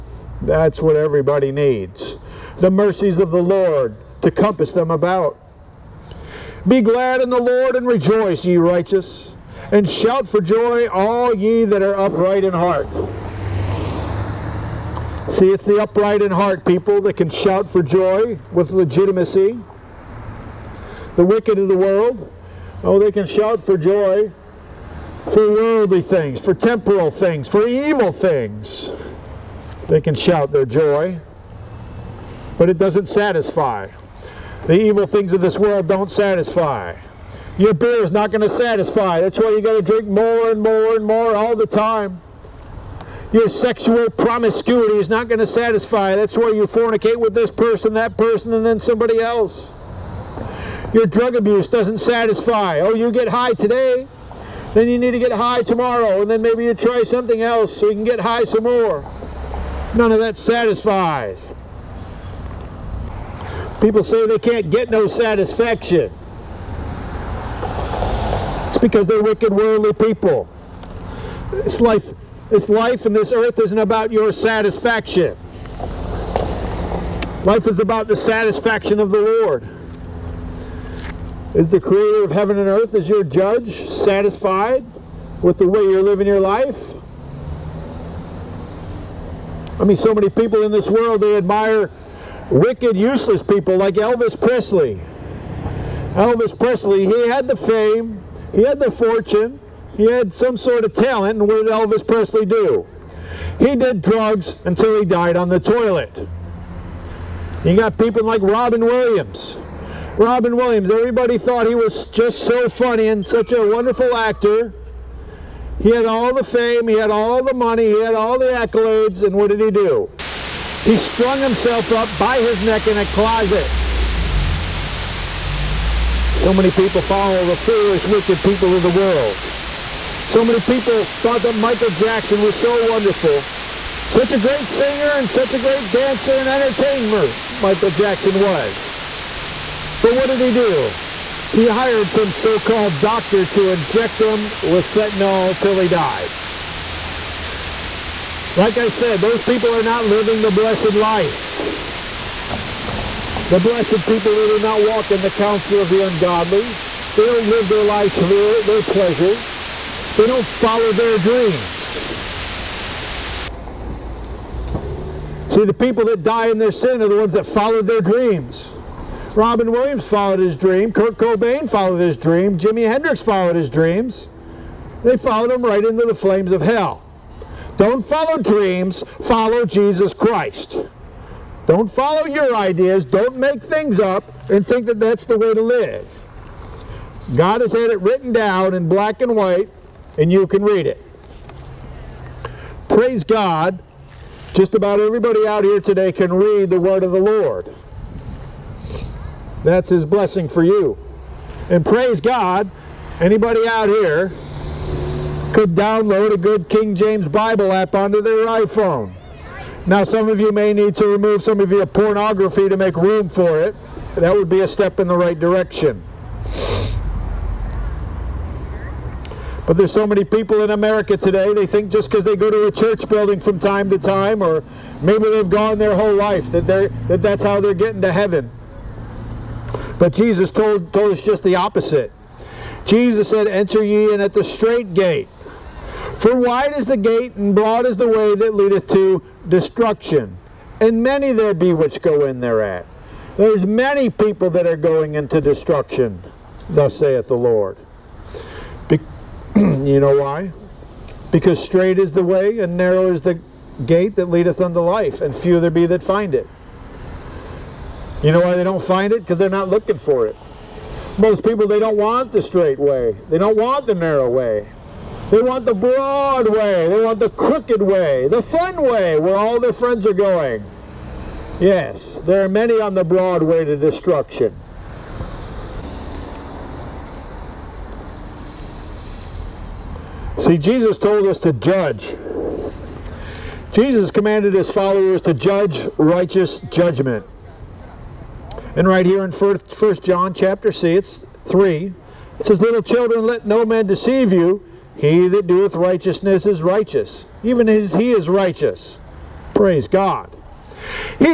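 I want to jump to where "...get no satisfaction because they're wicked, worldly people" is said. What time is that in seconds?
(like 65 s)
64 s.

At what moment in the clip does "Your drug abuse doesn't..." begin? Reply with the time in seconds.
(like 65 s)
50 s.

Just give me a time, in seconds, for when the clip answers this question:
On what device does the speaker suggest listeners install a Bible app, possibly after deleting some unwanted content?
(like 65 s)
208 s.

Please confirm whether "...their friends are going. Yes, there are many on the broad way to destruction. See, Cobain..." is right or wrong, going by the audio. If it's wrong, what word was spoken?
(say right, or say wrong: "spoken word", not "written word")
wrong: "Jesus", not "Cobain".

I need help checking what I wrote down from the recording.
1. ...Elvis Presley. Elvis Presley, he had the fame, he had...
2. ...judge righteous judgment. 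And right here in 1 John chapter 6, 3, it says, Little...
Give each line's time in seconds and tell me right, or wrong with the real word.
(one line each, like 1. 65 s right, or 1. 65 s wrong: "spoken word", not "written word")
1. 93 s right
2. 285 s right.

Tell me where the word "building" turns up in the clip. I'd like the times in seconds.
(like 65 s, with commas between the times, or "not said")
223 s.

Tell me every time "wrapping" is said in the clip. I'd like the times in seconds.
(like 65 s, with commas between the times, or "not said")
not said.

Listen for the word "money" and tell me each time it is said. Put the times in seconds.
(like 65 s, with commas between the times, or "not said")
117 s.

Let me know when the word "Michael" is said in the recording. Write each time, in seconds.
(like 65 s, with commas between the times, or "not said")
131 s, 137 s.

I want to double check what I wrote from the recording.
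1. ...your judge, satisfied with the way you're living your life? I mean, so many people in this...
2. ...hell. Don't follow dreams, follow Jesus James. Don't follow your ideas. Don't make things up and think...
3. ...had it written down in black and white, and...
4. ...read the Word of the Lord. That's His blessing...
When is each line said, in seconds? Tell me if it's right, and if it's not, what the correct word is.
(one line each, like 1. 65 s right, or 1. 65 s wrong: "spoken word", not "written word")
1. 83 s right
2. 176 s wrong: "Christ", not "James"
3. 187 s right
4. 196 s right.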